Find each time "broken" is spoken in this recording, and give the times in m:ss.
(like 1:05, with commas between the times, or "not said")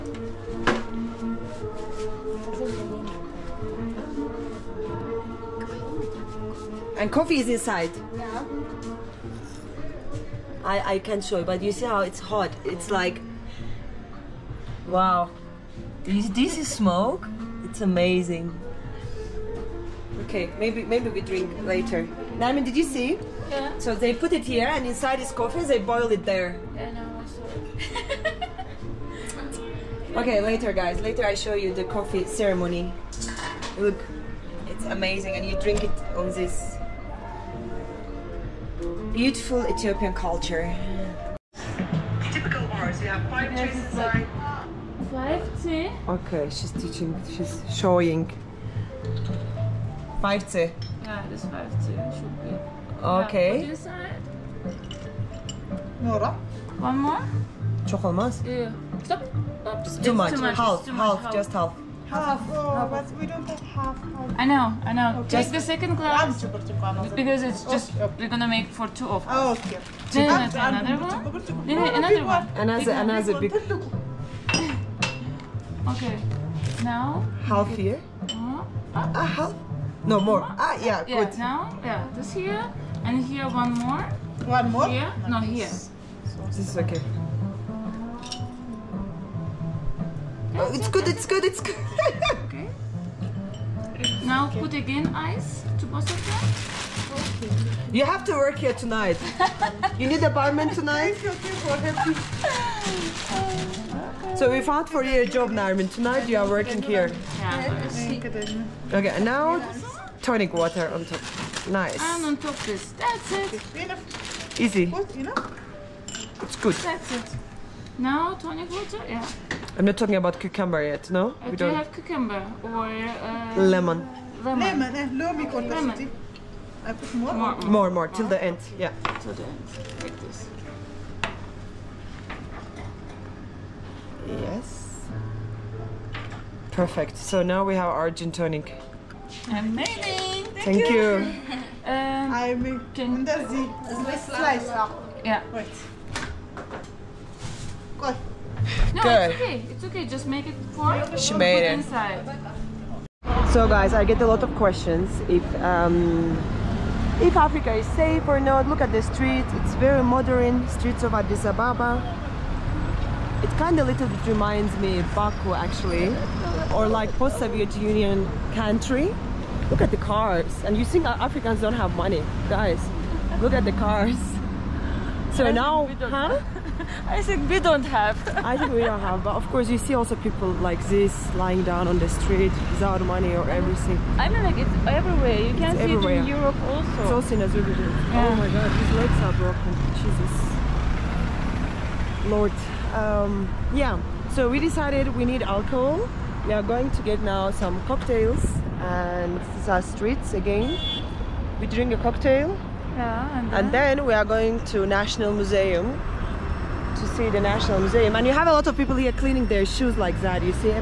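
3:09.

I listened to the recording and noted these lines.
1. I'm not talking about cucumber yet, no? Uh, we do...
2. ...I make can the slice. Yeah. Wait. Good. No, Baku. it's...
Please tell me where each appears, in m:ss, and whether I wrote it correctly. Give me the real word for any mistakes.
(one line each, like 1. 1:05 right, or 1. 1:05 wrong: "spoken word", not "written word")
1. 1:59 right
2. 2:22 wrong: "Good", not "Baku".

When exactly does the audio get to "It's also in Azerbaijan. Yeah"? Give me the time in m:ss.
3:07.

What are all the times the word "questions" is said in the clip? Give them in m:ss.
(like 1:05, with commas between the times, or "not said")
2:34.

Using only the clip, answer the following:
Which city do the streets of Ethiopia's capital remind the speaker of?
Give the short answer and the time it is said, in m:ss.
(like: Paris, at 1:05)
Baku, at 2:45.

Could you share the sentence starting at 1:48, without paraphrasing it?
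Okay, and now tonic water on top.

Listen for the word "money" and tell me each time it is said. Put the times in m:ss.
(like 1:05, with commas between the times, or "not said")
2:51, 3:03.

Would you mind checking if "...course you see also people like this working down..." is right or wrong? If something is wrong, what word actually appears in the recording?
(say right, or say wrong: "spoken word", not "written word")
wrong: "lying", not "working".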